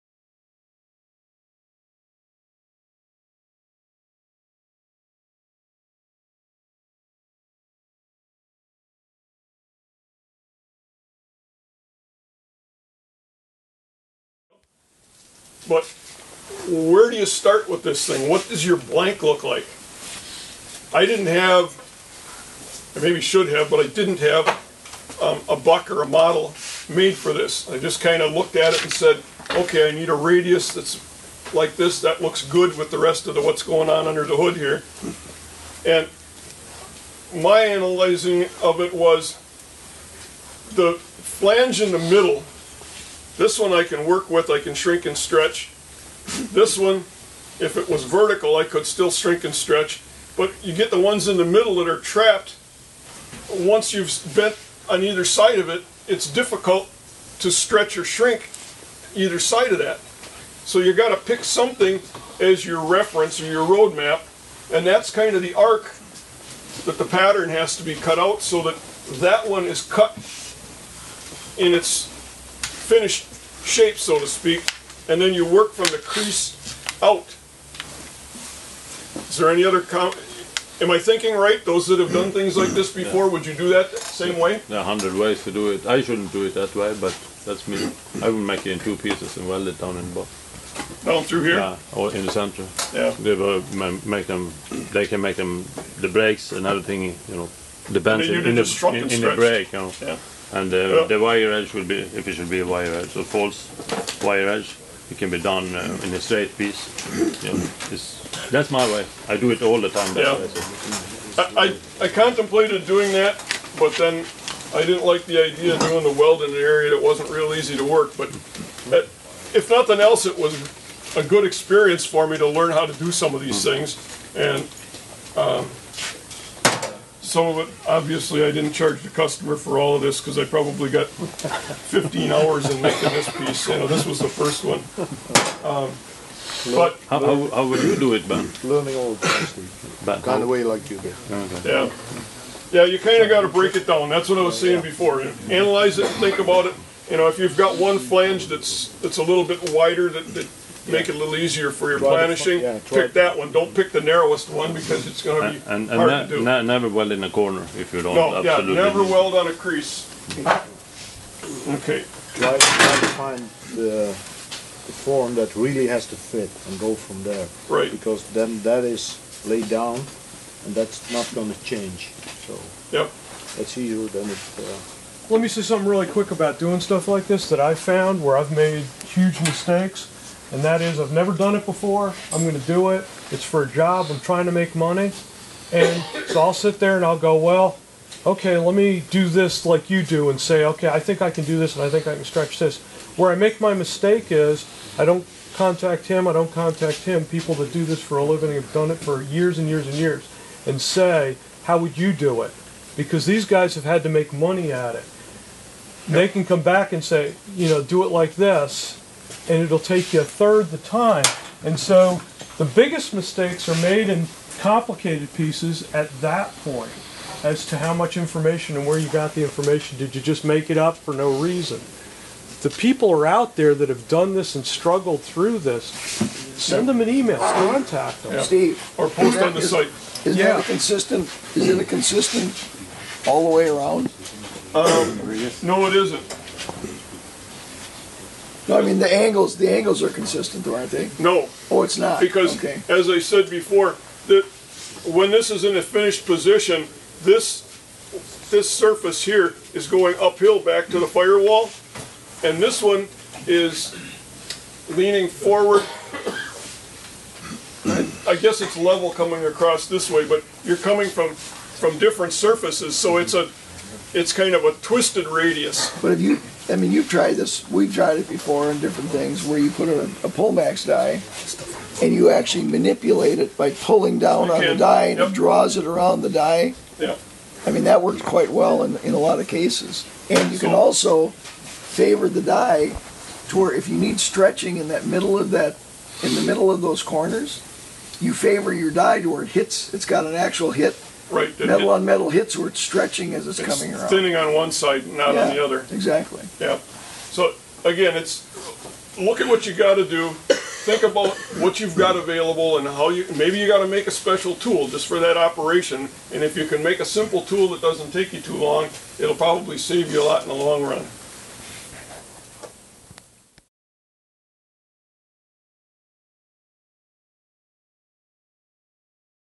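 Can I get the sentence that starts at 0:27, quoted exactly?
I just kind of looked at it and said, okay, I need a radius that's like this.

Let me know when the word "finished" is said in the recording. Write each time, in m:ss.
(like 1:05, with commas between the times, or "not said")
1:12, 4:05.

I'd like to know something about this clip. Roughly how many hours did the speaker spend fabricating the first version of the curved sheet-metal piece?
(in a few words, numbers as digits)
15.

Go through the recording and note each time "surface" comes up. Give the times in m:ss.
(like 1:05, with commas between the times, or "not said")
4:08, 4:22.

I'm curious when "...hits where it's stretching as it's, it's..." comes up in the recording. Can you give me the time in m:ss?
4:52.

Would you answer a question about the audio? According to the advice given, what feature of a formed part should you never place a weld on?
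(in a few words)
A crease.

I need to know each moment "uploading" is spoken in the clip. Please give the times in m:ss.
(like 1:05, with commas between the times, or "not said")
not said.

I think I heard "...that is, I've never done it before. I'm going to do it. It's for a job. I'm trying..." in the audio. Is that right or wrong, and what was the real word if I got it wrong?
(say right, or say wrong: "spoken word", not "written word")
right.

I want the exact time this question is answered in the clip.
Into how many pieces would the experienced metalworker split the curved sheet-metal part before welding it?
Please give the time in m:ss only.
1:28.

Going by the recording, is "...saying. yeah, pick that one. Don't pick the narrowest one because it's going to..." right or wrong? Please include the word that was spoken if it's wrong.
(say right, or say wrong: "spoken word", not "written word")
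wrong: "planishing", not "saying".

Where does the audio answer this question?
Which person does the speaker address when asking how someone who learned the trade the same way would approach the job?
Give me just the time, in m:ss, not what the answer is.
2:18.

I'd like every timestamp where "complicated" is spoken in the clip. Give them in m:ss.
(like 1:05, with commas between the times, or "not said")
3:34.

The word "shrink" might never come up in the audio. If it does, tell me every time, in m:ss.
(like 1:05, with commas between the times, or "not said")
0:44, 0:49, 0:58.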